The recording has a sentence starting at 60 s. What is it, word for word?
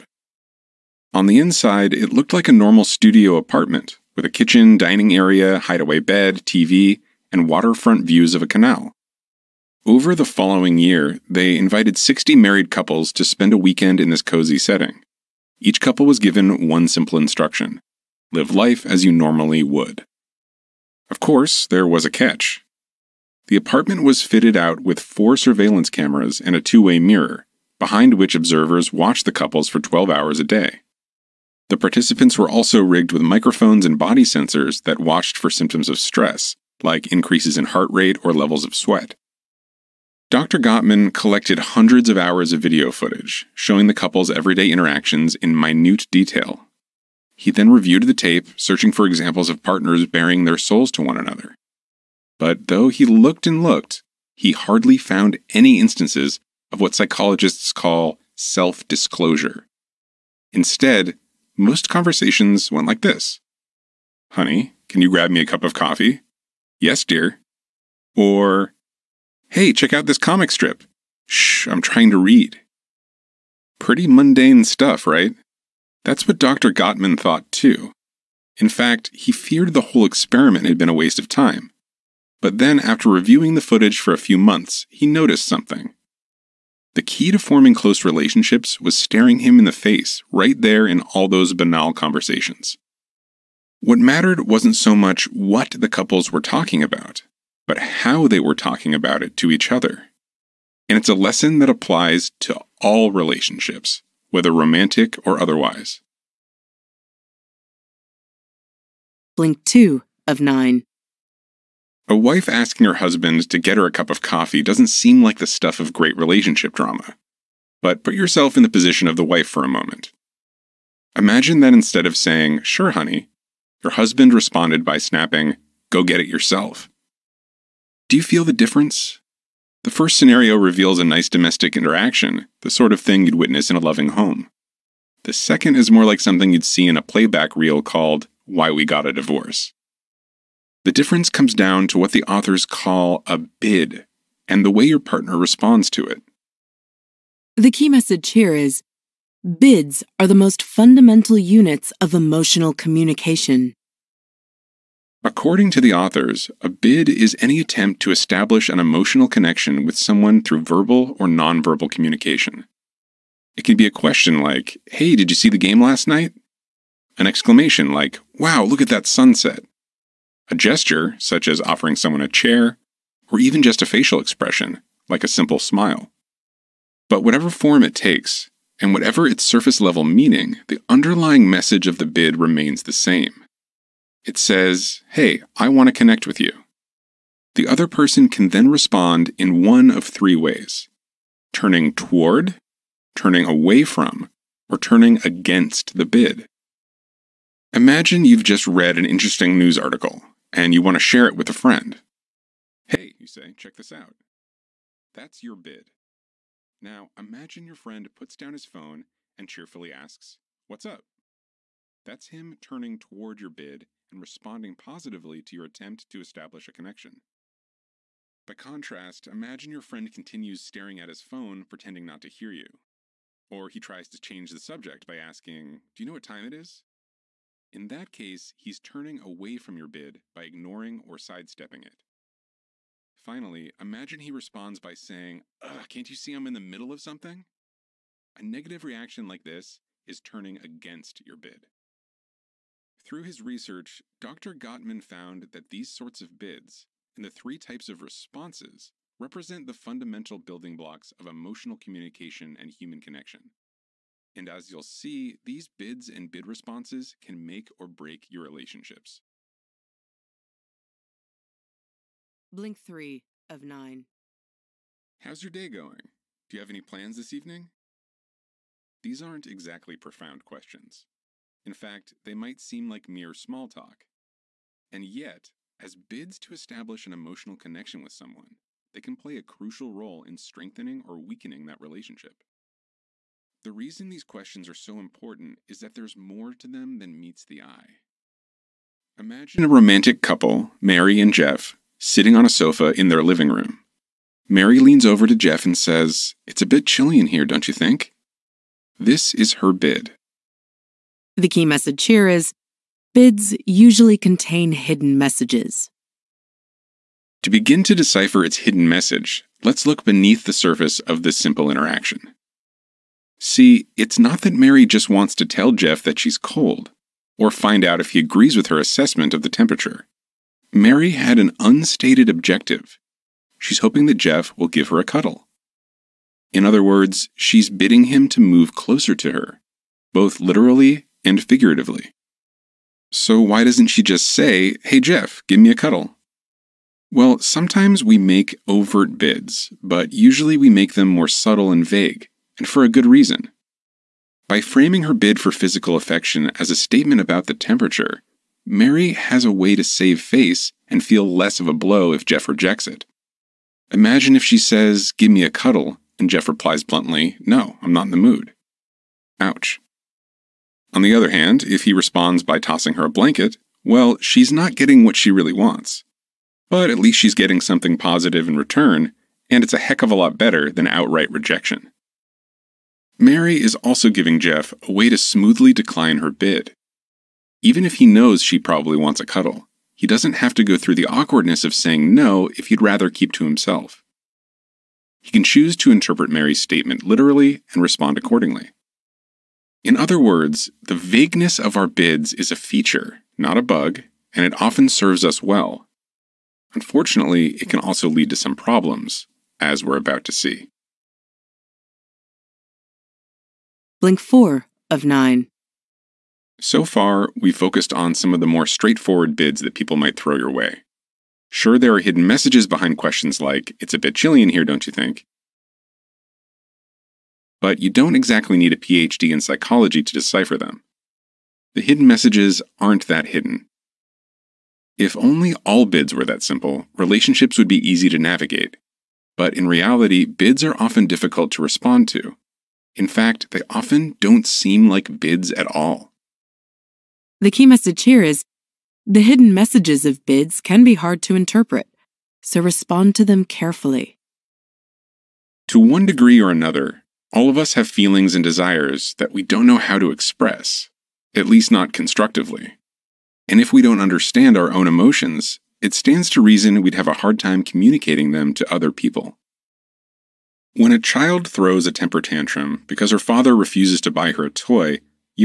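Instead, most conversations went like this Honey, can you grab me a cup of coffee?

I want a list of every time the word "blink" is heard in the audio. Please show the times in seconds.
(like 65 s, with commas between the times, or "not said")
109 s, 262 s, 404 s.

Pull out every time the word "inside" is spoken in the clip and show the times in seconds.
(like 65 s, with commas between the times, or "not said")
1 s.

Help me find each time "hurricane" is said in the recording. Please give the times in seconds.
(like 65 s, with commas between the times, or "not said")
not said.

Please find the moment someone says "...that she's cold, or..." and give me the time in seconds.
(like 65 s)
316 s.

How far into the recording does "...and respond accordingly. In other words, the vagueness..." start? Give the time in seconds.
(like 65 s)
387 s.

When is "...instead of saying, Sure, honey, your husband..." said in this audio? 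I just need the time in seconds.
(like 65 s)
121 s.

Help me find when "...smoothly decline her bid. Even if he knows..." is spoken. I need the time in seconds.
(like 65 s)
375 s.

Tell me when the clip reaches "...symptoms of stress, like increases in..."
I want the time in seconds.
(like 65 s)
35 s.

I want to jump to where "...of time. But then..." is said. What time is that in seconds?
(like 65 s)
81 s.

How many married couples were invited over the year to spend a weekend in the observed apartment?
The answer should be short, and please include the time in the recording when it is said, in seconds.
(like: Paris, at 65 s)
60, at 11 s.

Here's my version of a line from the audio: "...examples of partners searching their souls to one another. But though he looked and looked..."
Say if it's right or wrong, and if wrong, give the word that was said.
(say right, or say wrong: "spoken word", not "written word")
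wrong: "bearing", not "searching".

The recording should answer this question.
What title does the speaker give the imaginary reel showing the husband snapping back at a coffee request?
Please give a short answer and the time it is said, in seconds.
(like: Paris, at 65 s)
Why We Got a Divorce, at 138 s.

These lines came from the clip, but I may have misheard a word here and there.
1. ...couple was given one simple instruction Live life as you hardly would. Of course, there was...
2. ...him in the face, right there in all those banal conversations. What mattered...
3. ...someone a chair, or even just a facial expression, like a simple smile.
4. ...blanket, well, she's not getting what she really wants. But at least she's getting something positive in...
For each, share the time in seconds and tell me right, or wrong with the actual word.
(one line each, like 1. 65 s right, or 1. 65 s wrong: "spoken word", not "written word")
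1. 15 s wrong: "normally", not "hardly"
2. 89 s right
3. 171 s right
4. 363 s right.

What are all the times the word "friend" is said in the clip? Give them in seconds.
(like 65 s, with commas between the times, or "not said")
201 s, 207 s, 219 s.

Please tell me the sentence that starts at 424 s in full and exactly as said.
If only all bids were that simple, relationships would be easy to navigate.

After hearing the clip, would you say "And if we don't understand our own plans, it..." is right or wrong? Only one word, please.
wrong.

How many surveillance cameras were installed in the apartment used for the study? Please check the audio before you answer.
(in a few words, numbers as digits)
4.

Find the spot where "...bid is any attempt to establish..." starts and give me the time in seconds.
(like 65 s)
156 s.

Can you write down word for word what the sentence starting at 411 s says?
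Sure, there are hidden messages behind questions like, it's a bit chilly in here, don't you think?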